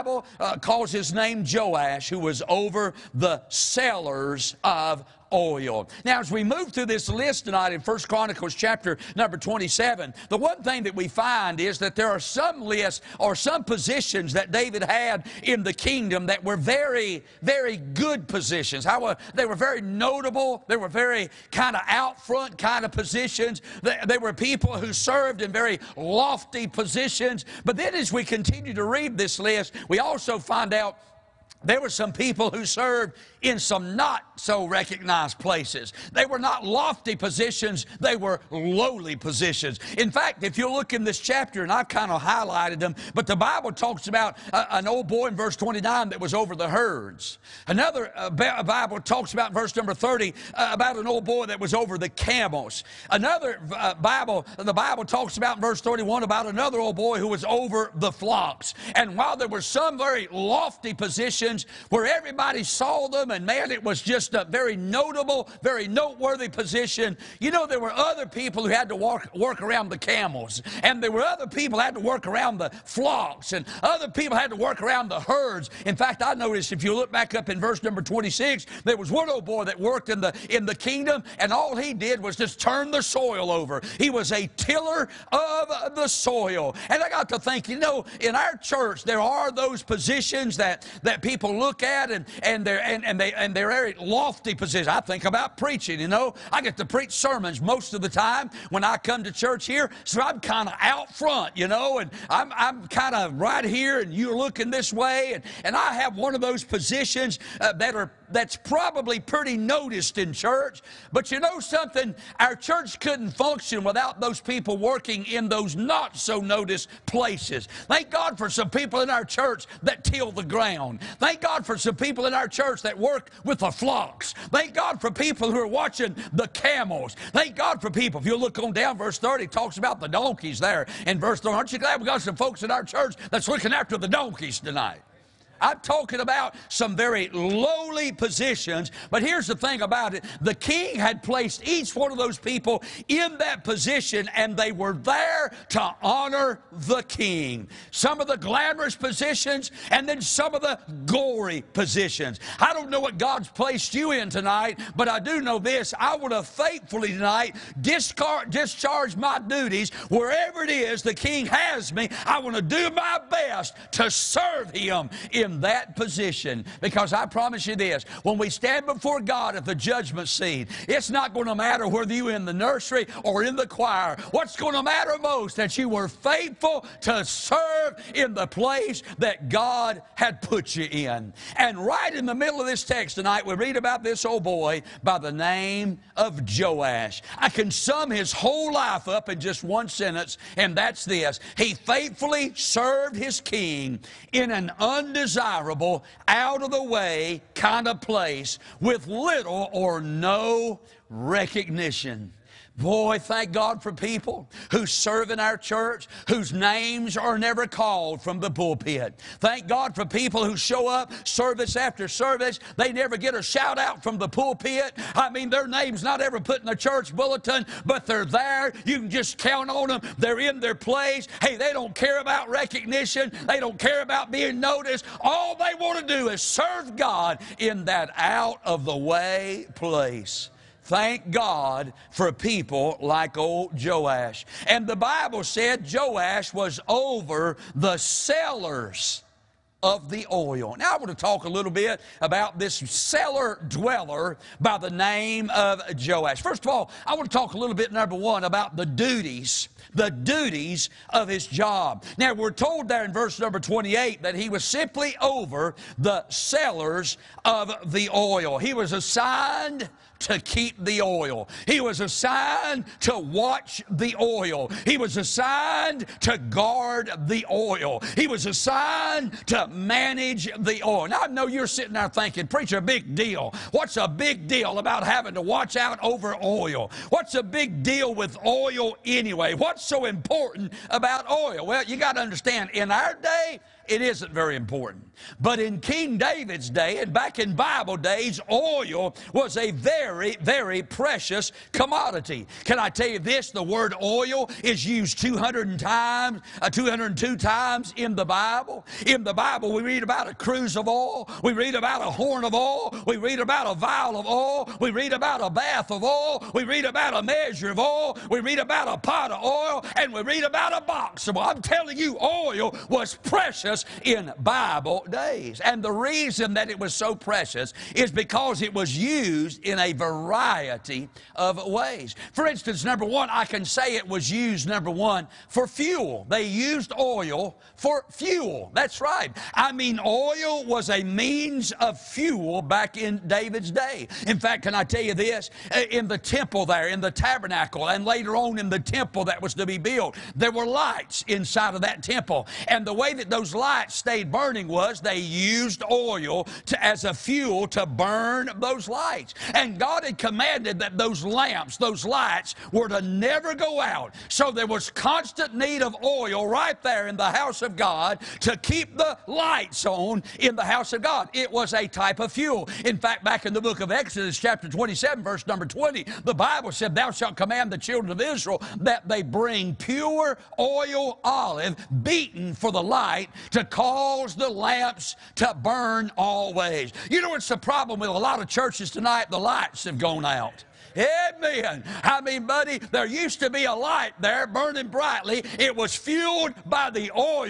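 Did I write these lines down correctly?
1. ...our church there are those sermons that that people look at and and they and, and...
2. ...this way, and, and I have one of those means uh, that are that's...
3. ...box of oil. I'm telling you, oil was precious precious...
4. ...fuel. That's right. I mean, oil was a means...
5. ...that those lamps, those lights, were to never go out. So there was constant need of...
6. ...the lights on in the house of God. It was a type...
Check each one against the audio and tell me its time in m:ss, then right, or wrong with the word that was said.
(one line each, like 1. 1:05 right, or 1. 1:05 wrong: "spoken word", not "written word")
1. 1:28 wrong: "positions", not "sermons"
2. 1:44 wrong: "positions", not "means"
3. 5:10 right
4. 5:28 right
5. 5:50 right
6. 5:58 right.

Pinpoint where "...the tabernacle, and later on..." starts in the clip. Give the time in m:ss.
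5:36.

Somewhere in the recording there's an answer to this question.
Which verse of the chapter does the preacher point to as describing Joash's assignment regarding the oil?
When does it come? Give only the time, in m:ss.
4:13.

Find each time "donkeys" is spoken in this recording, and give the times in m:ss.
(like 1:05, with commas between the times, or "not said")
2:10, 2:14.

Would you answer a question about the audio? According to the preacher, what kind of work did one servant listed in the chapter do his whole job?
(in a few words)
Tiller of the soil.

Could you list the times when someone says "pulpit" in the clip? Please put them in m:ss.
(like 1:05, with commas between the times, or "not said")
3:28, 3:34.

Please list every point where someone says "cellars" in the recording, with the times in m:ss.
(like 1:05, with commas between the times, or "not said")
0:03, 3:57, 4:02, 4:16.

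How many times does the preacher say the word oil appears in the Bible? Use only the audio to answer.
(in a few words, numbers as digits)
202.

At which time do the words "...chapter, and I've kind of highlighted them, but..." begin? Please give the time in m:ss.
0:41.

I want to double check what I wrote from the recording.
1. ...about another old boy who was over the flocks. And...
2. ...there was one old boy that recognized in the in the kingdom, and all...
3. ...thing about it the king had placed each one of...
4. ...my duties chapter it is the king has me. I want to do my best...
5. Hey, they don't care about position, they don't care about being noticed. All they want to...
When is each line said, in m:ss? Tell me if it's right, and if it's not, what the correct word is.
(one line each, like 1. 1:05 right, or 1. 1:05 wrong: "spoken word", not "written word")
1. 0:56 right
2. 1:18 wrong: "worked", not "recognized"
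3. 2:19 right
4. 2:39 wrong: "wherever", not "chapter"
5. 3:41 wrong: "recognition", not "position".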